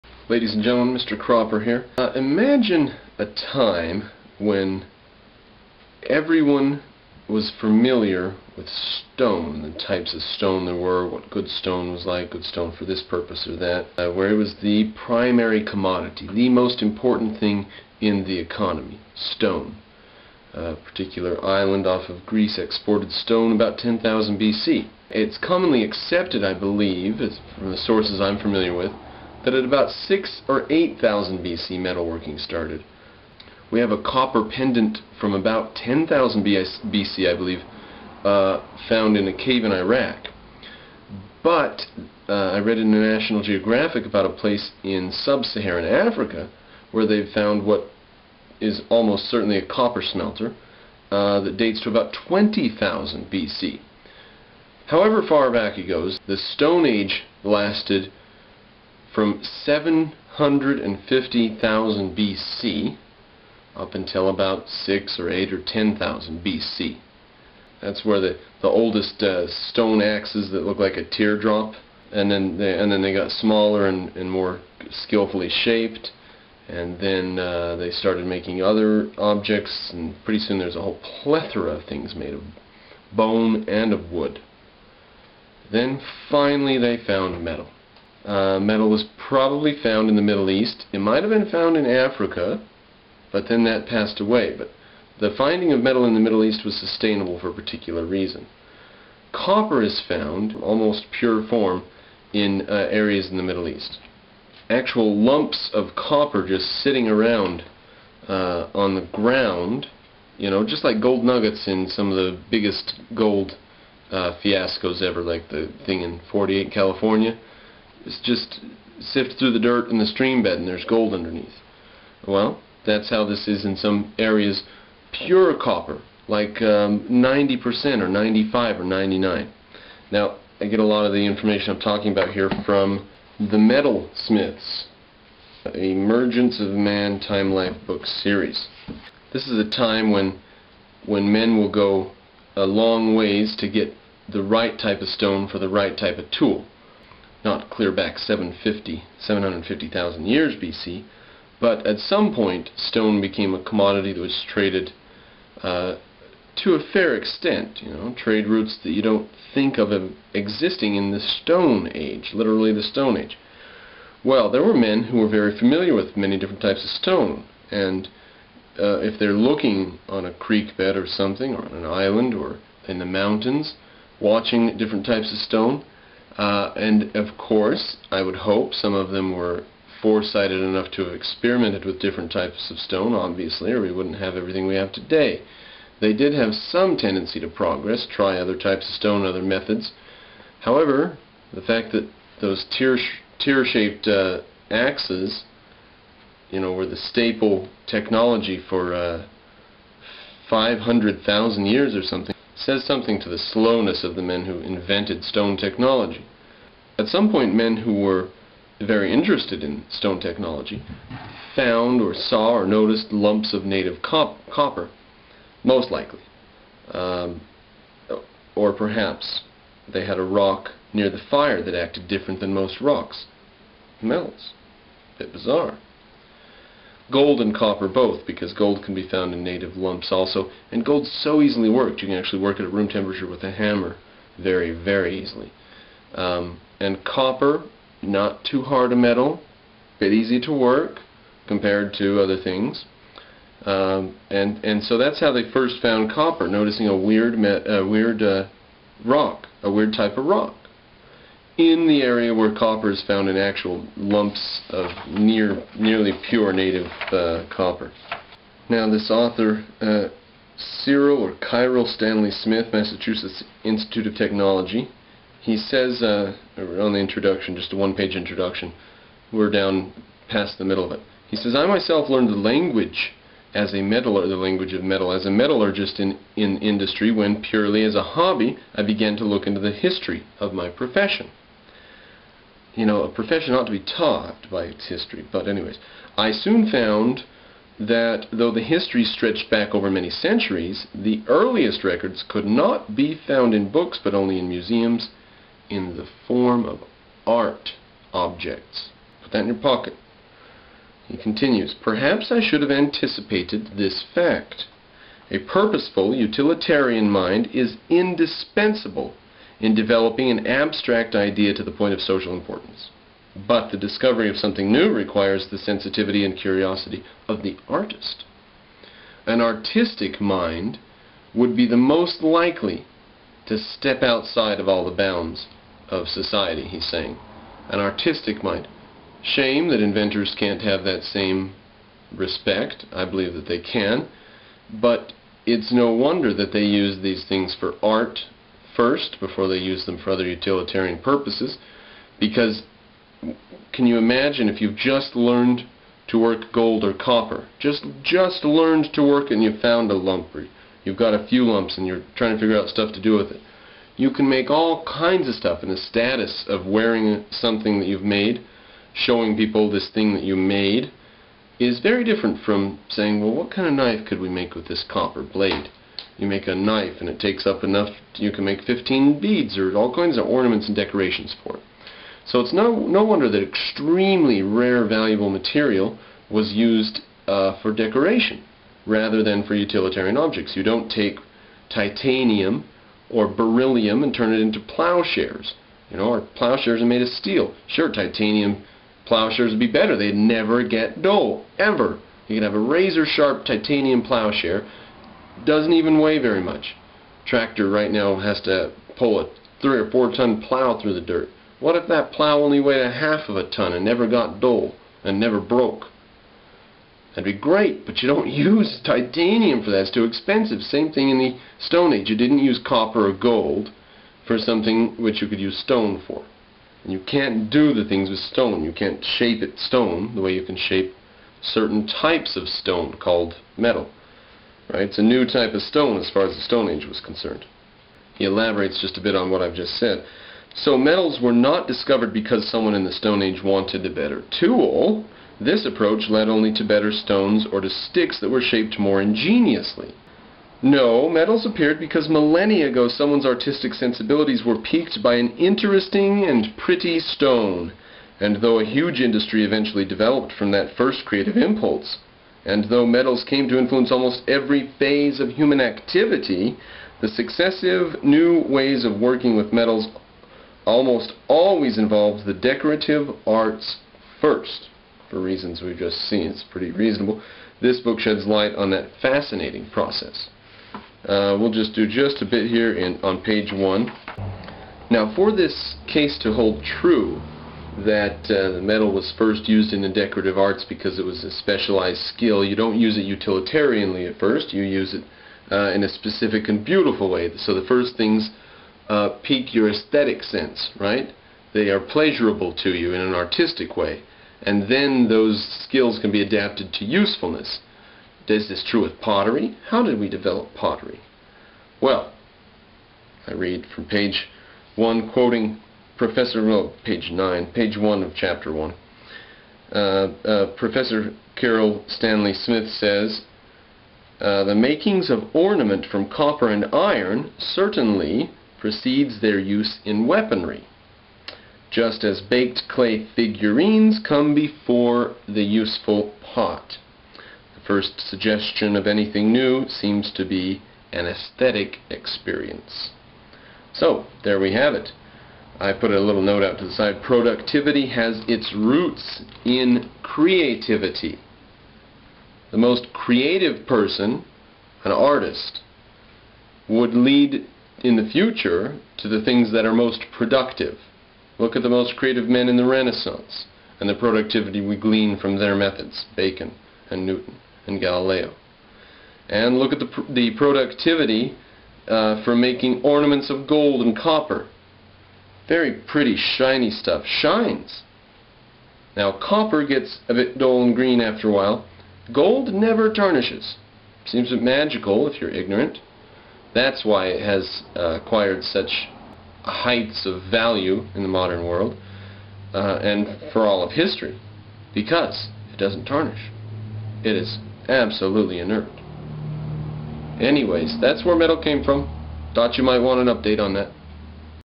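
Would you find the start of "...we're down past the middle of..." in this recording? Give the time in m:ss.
4:29.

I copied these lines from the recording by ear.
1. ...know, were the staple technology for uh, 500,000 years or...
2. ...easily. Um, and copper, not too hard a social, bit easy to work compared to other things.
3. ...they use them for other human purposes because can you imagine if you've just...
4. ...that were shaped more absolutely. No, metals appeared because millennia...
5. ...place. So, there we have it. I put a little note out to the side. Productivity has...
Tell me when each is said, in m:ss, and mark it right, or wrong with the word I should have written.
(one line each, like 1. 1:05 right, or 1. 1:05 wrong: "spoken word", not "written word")
1. 3:16 right
2. 3:55 wrong: "metal", not "social"
3. 5:39 wrong: "utilitarian", not "human"
4. 7:18 wrong: "ingeniously", not "absolutely"
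5. 8:51 wrong: "experience", not "place".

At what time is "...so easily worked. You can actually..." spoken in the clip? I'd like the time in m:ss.
3:51.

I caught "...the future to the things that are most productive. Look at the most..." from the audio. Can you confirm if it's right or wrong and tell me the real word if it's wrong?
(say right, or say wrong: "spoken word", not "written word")
right.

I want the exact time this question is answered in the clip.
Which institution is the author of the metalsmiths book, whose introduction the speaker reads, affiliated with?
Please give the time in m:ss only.
4:22.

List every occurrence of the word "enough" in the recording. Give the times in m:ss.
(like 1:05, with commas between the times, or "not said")
3:00, 6:07.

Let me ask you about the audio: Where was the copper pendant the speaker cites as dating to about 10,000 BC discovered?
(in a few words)
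A cave in Iraq.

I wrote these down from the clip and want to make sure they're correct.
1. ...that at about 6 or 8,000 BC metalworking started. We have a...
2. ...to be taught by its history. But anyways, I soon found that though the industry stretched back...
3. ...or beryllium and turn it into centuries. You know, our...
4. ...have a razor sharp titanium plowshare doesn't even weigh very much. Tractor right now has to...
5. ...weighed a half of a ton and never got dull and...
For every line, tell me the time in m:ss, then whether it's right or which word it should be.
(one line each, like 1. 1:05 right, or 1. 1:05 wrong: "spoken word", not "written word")
1. 0:29 right
2. 4:43 wrong: "history", not "industry"
3. 6:23 wrong: "plowshares", not "centuries"
4. 6:32 right
5. 6:42 right.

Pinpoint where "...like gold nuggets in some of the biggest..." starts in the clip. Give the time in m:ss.
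1:50.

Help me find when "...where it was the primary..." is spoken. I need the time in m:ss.
0:14.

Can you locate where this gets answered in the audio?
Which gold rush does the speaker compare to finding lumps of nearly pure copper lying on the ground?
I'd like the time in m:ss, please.
1:56.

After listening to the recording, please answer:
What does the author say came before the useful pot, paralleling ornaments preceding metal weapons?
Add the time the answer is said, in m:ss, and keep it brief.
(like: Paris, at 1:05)
Baked clay figurines, at 8:42.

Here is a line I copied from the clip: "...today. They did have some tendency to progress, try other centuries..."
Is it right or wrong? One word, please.
wrong.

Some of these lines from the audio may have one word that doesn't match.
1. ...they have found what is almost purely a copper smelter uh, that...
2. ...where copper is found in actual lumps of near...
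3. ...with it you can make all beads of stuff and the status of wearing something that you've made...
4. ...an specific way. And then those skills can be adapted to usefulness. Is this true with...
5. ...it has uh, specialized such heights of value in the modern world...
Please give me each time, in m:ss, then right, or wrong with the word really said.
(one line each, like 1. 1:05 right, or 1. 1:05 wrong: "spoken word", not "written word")
1. 0:47 wrong: "certainly", not "purely"
2. 4:12 right
3. 5:53 wrong: "kinds", not "beads"
4. 8:13 wrong: "artistic", not "specific"
5. 9:37 wrong: "acquired", not "specialized".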